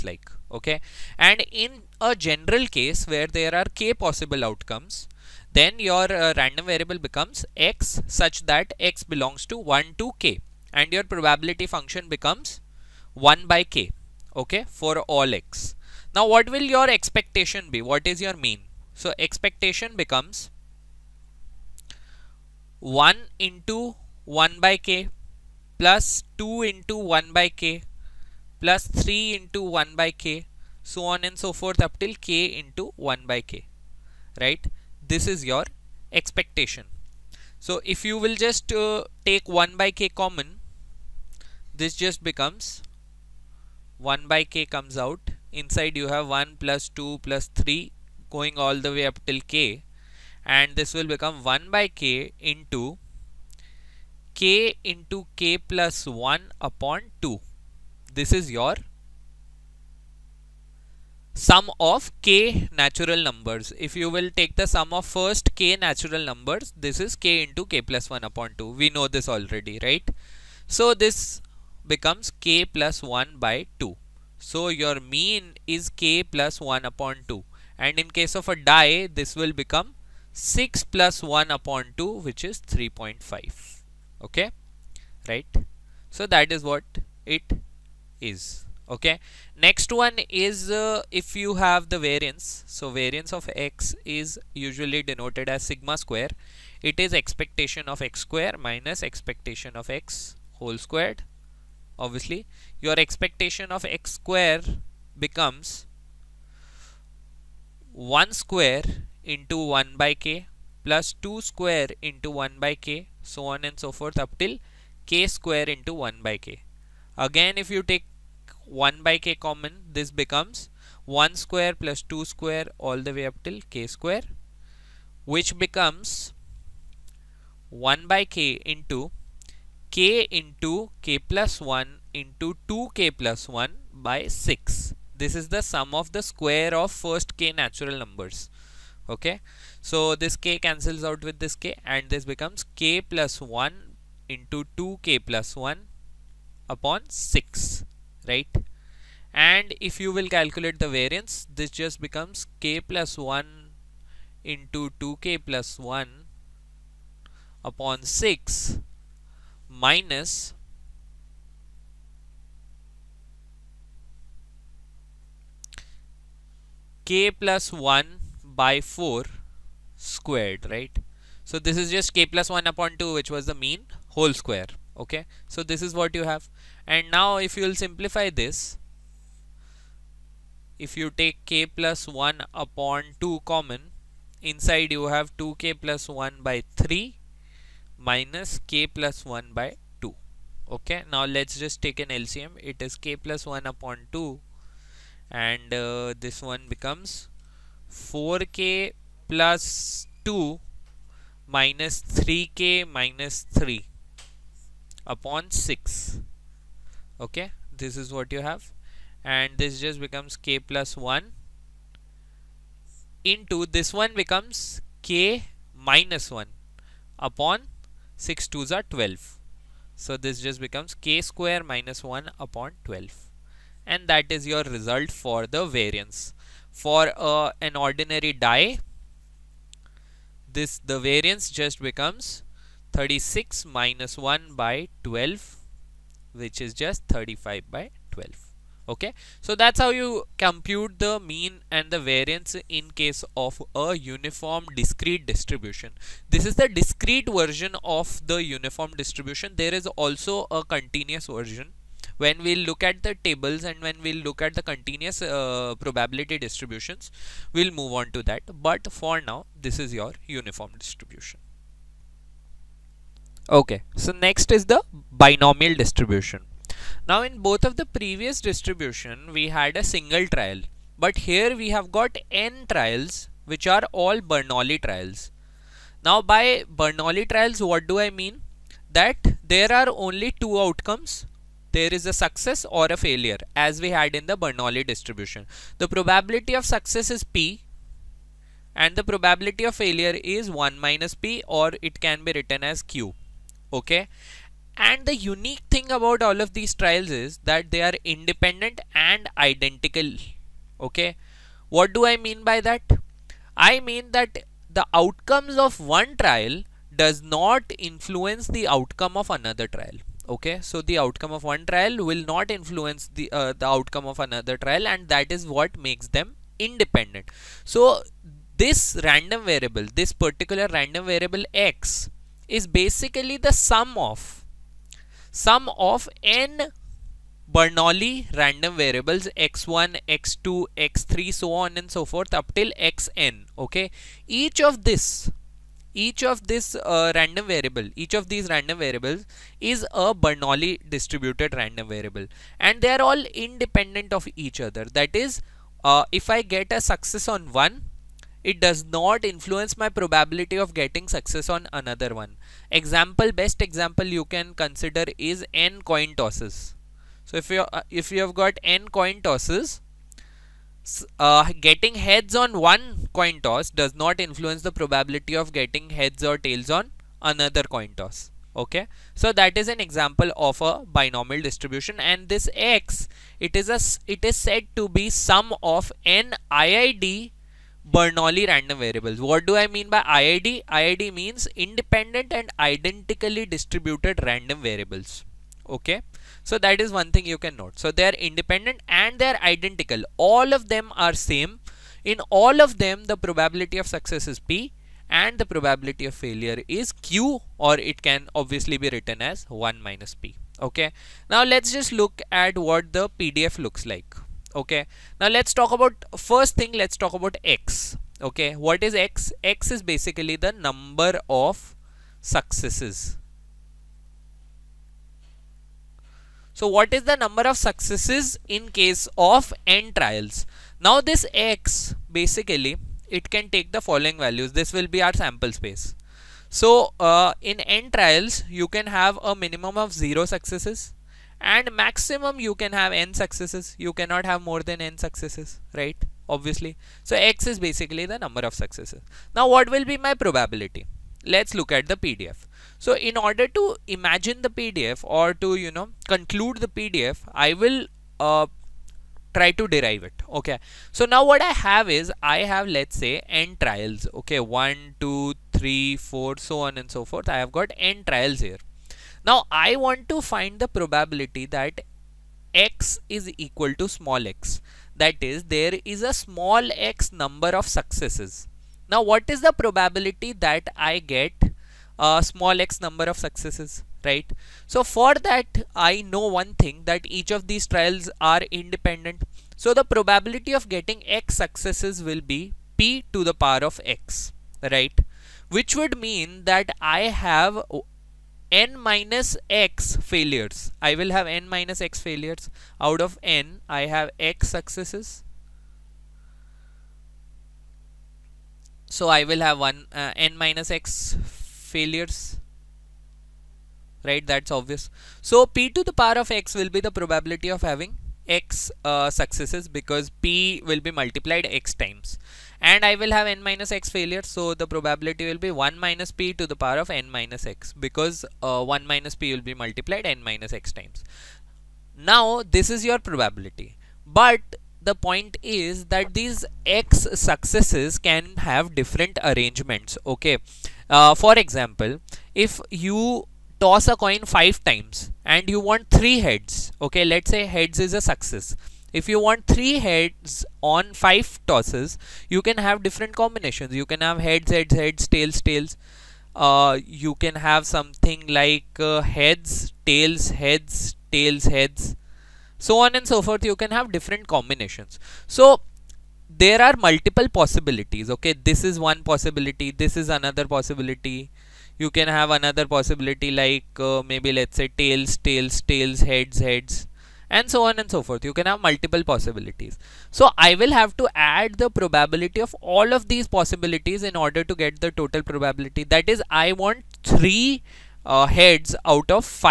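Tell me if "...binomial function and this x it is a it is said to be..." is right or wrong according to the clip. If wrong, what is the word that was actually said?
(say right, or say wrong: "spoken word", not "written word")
wrong: "distribution", not "function".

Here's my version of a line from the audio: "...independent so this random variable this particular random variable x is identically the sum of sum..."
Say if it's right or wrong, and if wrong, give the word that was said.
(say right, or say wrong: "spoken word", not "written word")
wrong: "basically", not "identically".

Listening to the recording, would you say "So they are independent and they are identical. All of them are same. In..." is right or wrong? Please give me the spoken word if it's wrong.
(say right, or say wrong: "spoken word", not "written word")
right.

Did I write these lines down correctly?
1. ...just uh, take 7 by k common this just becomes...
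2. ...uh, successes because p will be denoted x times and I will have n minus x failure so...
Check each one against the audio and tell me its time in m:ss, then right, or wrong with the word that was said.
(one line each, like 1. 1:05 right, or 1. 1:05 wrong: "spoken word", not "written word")
1. 0:38 wrong: "1", not "7"
2. 8:28 wrong: "multiplied", not "denoted".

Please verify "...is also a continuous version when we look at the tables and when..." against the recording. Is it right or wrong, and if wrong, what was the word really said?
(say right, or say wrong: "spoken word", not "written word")
right.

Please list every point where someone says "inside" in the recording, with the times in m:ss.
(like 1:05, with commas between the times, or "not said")
0:45, 3:04.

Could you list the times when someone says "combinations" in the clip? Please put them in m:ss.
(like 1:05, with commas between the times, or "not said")
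9:03, 9:14.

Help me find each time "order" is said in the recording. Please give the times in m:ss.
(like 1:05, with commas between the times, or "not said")
7:23, 9:34.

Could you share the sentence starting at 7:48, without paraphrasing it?
Now what is the probability that I get a small x number of successes?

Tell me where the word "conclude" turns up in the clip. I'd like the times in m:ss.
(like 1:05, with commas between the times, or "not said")
7:26.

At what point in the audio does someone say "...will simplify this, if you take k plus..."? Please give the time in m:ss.
2:57.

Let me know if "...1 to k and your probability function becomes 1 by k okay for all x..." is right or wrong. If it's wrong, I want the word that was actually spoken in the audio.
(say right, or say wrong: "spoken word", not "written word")
right.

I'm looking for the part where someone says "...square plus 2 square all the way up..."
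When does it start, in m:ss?
2:01.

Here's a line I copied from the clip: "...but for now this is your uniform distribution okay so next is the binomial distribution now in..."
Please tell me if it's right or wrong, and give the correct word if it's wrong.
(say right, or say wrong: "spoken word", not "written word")
right.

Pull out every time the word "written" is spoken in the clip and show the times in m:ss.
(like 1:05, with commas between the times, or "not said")
4:52, 6:38.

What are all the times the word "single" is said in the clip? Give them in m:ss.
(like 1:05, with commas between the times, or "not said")
4:29.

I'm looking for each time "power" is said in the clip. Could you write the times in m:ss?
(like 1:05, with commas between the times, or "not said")
8:03, 8:26, 8:36.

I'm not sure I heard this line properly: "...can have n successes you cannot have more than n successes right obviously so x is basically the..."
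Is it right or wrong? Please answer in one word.
right.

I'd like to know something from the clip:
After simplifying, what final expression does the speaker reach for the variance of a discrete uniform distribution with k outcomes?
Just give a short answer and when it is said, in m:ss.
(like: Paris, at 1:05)
k squared minus 1 over 12, at 3:40.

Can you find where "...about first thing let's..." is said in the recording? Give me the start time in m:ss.
6:45.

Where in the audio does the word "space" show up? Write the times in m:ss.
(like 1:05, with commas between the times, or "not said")
7:05.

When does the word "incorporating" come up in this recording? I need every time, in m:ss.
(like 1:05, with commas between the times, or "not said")
not said.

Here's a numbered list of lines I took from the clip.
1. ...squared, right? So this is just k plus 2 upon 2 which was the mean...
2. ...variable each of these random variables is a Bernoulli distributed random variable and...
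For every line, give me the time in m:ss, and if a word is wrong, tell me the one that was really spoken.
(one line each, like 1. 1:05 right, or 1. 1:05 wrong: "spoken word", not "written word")
1. 2:49 wrong: "1", not "2"
2. 5:37 right.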